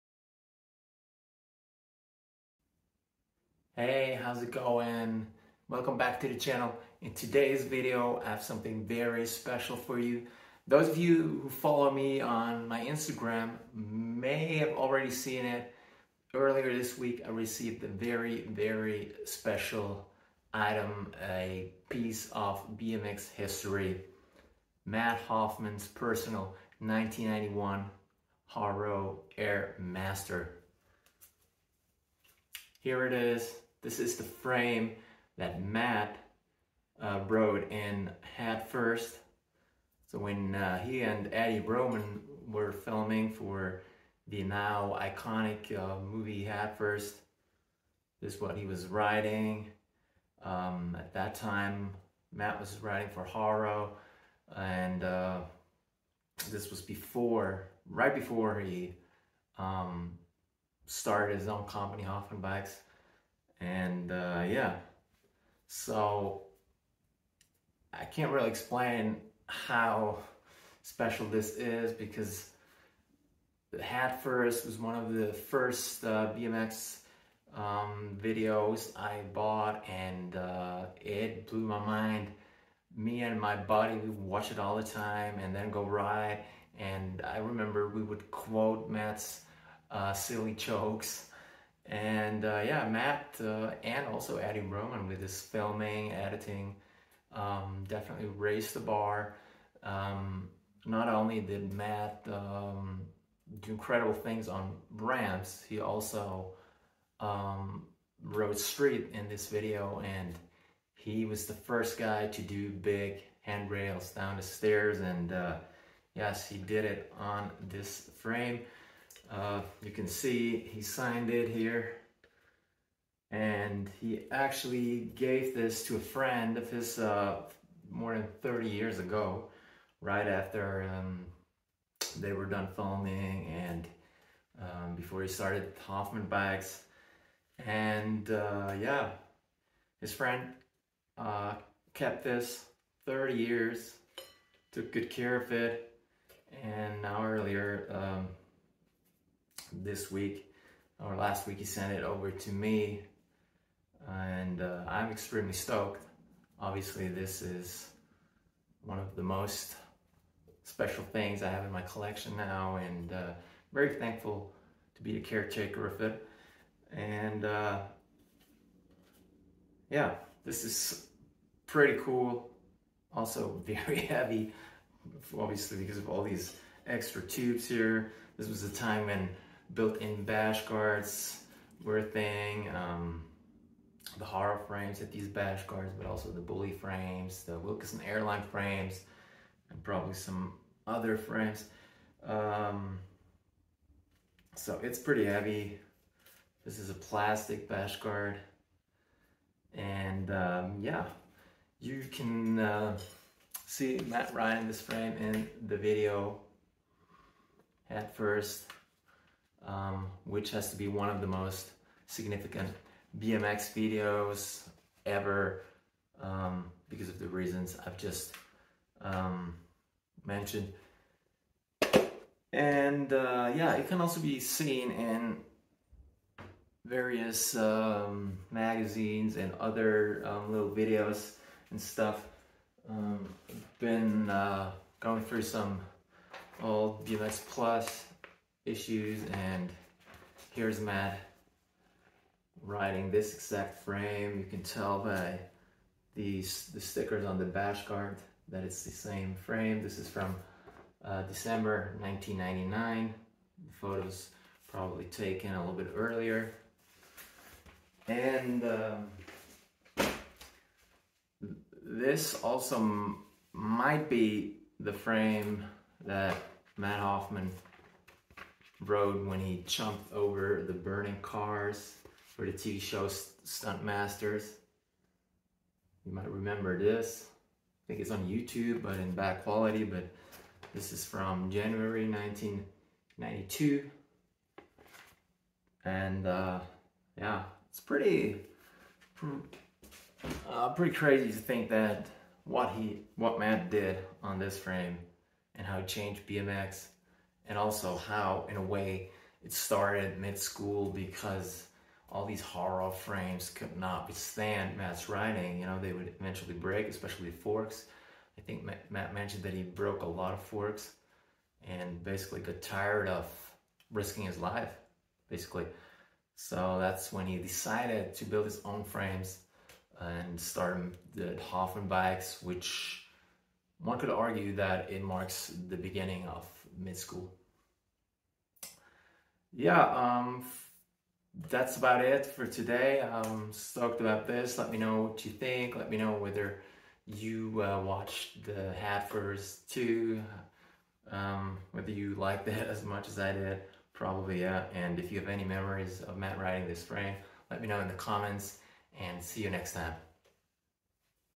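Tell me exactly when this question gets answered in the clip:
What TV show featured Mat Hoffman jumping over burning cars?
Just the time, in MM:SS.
04:33.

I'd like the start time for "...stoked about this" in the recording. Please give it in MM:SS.
05:33.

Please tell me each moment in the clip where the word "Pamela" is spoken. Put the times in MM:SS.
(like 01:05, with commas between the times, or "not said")
not said.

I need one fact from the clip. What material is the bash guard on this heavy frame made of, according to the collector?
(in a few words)
plastic.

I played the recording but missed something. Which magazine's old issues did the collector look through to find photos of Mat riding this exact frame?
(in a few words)
BMX Plus.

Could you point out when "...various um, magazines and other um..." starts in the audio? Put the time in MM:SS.
03:46.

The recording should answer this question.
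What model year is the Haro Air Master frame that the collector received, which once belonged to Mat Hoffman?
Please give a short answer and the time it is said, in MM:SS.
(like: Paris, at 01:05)
1991, at 00:26.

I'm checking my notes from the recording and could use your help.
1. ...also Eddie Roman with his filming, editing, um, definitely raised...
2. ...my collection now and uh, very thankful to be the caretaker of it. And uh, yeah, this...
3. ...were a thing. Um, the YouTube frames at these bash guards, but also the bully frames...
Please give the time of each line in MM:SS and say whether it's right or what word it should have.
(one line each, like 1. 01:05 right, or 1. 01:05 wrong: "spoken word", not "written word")
1. 01:34 right
2. 02:41 right
3. 03:01 wrong: "Haro", not "YouTube".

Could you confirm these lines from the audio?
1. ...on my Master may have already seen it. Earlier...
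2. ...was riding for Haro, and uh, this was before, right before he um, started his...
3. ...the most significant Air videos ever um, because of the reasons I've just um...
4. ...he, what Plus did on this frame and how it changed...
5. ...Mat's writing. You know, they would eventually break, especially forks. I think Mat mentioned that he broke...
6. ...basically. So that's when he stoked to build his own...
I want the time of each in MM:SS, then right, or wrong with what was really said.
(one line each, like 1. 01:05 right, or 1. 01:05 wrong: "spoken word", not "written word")
1. 00:12 wrong: "Instagram", not "Master"
2. 00:52 right
3. 03:31 wrong: "BMX", not "Air"
4. 04:52 wrong: "Mat", not "Plus"
5. 05:04 right
6. 05:15 wrong: "decided", not "stoked".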